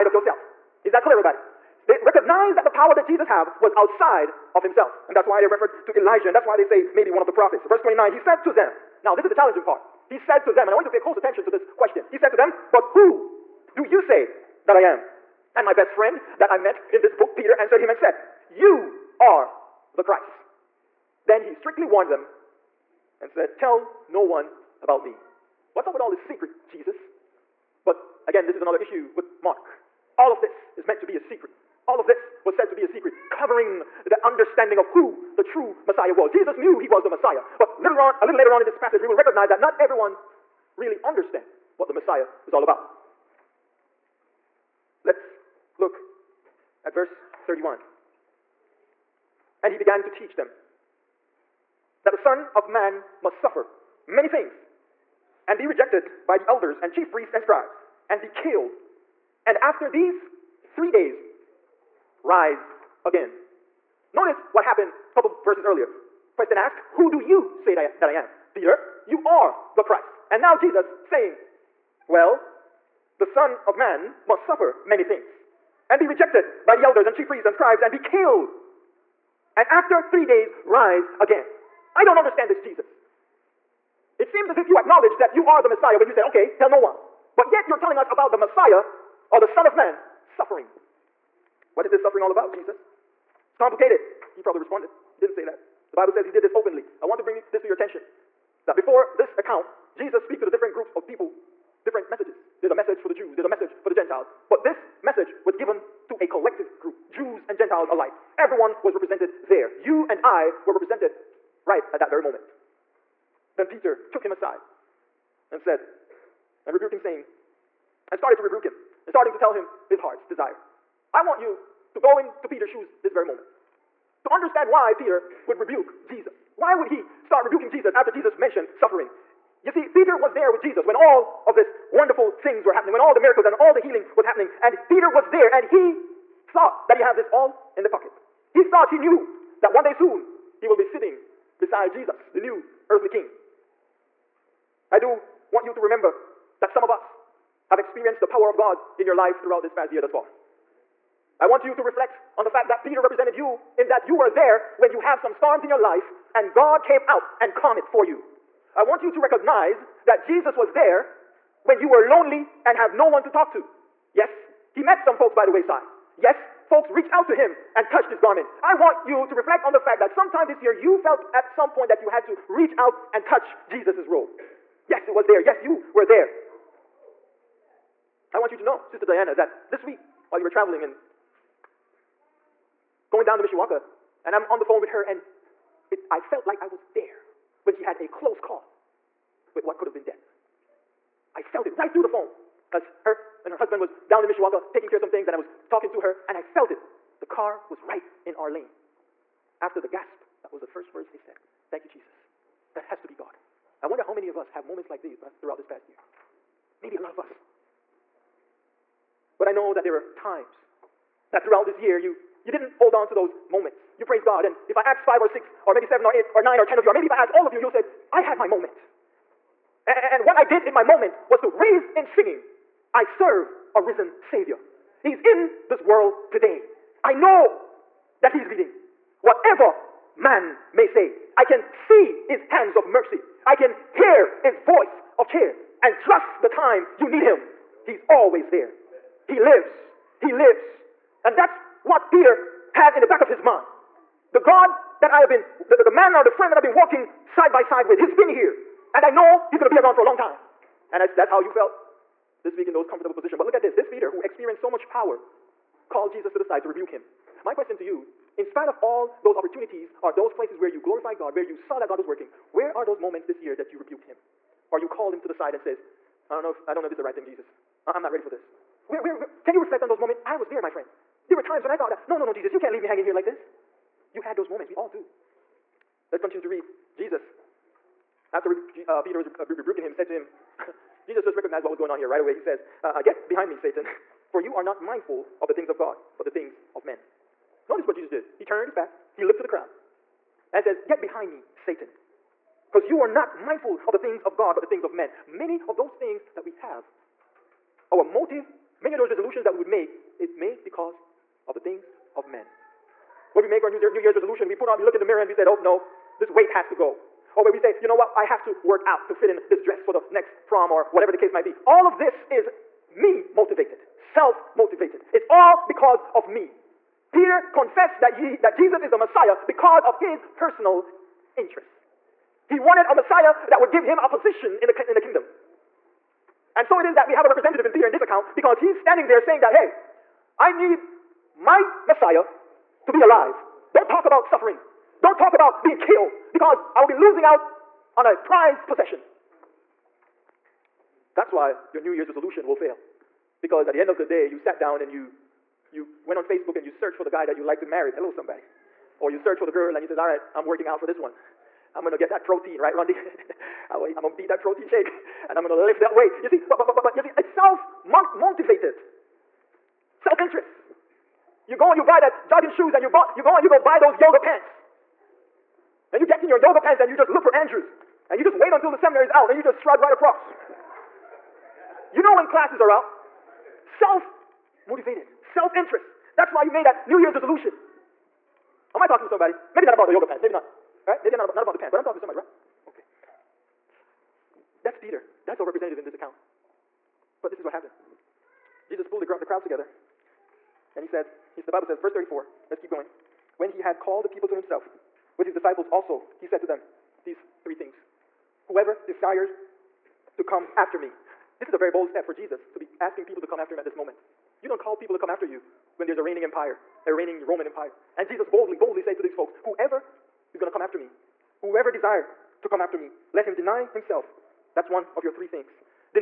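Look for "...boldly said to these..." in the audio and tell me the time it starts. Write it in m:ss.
6:48.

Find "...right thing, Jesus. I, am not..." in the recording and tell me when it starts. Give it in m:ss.
4:27.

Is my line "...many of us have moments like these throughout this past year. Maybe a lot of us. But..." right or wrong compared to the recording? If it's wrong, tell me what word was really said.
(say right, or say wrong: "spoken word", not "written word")
right.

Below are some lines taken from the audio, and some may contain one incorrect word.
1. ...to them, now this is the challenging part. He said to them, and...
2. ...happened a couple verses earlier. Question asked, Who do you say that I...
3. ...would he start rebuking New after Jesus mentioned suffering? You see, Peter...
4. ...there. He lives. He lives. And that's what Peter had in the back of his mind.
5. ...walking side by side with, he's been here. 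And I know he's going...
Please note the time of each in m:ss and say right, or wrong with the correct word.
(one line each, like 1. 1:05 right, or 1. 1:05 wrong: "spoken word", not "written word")
1. 0:08 right
2. 1:04 right
3. 2:06 wrong: "Jesus", not "New"
4. 3:58 right
5. 4:06 right.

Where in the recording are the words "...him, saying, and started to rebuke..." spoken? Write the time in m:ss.
1:56.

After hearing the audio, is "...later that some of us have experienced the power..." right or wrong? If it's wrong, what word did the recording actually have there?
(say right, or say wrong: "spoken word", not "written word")
wrong: "remember", not "later".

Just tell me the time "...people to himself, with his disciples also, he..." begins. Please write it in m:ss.
6:34.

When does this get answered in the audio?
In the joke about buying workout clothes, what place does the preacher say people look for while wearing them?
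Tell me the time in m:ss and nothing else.
6:07.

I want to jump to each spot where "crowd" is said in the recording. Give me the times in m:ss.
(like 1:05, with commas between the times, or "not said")
4:49, 6:29.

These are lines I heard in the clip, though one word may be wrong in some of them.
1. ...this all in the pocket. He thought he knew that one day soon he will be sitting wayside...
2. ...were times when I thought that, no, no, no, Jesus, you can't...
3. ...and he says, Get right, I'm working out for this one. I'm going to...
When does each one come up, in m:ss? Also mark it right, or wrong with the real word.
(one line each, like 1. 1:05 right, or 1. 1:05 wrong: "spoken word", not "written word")
1. 2:17 wrong: "beside", not "wayside"
2. 4:31 right
3. 5:49 wrong: "All", not "Get".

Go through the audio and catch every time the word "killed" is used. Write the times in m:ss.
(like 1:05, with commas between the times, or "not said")
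0:58, 1:17, 5:35.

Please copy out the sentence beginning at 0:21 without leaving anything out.
Then he strictly warned them and said, Tell no one about me.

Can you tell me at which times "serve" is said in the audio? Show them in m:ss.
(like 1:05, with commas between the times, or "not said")
3:43.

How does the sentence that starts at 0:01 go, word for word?
They recognize that the power that Jesus have was outside of himself.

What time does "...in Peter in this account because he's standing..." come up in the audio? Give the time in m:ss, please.
5:27.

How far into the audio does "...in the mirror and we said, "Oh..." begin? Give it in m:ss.
5:04.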